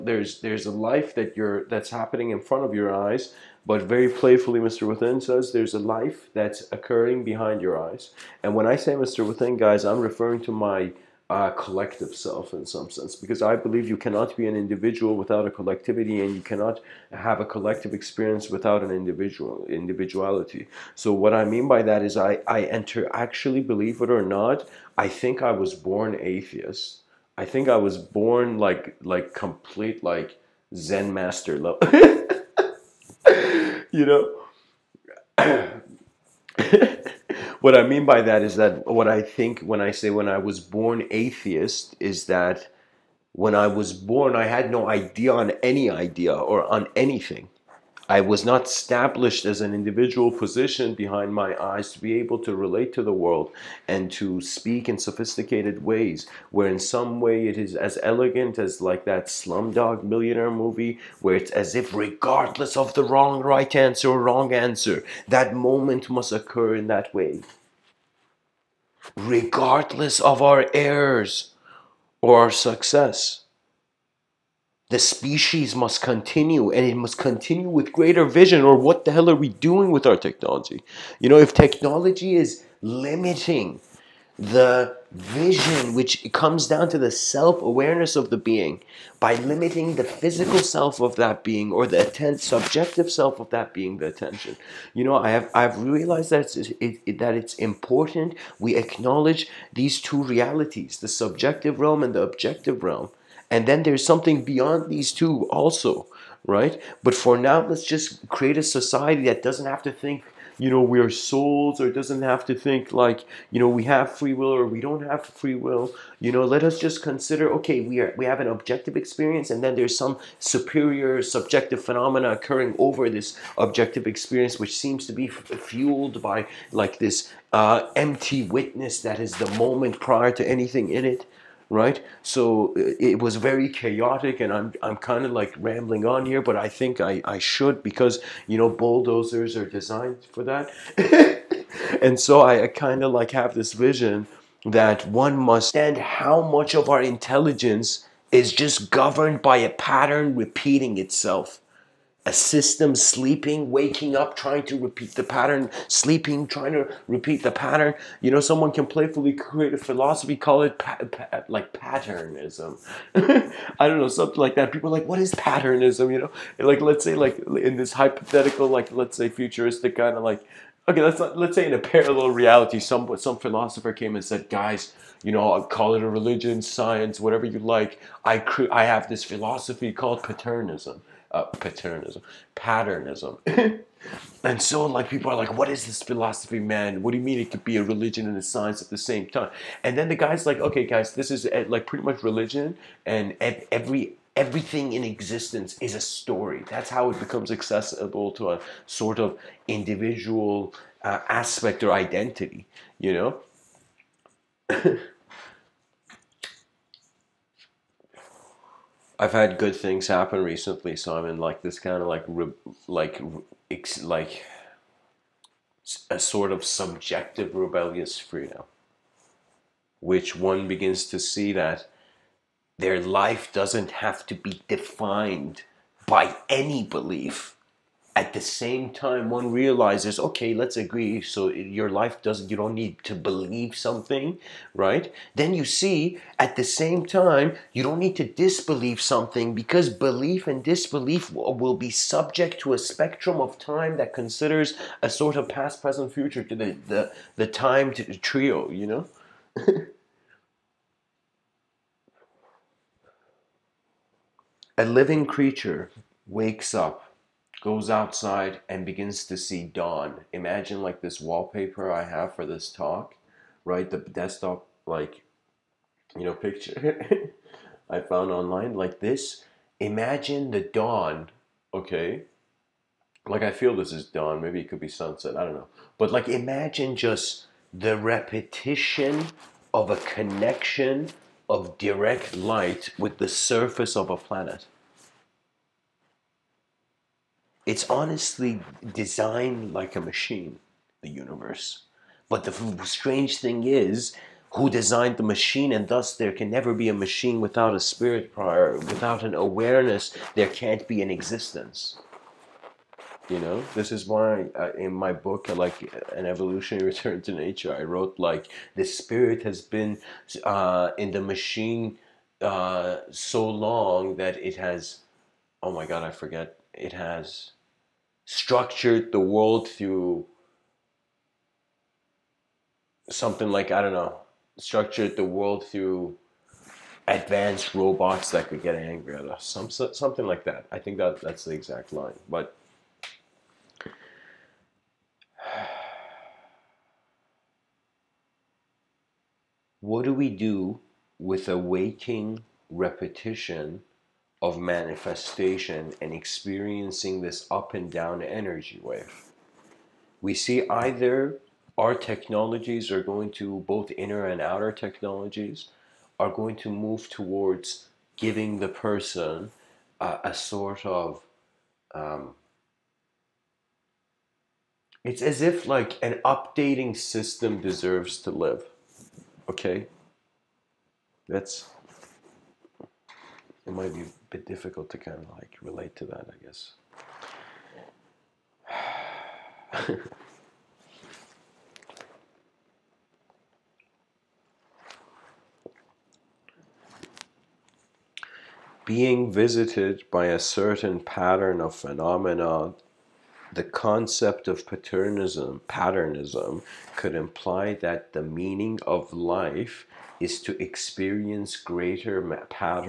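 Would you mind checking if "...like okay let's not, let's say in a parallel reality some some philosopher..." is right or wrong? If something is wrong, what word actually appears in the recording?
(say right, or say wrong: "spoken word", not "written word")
right.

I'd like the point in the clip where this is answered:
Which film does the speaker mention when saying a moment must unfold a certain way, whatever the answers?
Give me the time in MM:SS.
00:59.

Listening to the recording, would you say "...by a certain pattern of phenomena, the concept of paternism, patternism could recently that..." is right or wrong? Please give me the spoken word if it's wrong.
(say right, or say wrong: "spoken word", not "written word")
wrong: "imply", not "recently".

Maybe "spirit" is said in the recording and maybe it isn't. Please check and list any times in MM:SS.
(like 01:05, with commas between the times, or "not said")
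04:57, 05:08.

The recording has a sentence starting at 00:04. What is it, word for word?
Within says there's a life that's occurring behind your eyes.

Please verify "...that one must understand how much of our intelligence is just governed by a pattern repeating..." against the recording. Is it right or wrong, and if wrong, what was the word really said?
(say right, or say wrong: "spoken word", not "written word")
right.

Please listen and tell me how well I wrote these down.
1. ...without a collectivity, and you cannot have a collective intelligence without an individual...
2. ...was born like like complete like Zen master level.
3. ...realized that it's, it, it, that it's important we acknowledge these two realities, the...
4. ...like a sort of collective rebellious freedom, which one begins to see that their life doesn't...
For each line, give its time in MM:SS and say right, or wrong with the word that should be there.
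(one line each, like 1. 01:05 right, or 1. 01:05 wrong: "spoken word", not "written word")
1. 00:15 wrong: "experience", not "intelligence"
2. 00:27 right
3. 01:35 right
4. 03:34 wrong: "subjective", not "collective".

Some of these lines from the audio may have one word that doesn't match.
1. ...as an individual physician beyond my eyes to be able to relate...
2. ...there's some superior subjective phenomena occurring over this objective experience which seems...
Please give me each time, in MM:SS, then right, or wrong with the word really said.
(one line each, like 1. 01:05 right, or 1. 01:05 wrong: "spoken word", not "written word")
1. 00:49 wrong: "behind", not "beyond"
2. 01:59 right.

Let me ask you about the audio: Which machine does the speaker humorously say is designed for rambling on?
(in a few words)
bulldozers.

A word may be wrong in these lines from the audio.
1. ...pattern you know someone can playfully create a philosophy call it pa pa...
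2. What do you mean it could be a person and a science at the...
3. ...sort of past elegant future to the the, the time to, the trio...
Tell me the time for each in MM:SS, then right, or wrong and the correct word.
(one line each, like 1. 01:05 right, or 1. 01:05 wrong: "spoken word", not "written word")
1. 02:37 right
2. 03:07 wrong: "religion", not "person"
3. 04:05 wrong: "present", not "elegant".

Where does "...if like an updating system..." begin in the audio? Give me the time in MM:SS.
06:05.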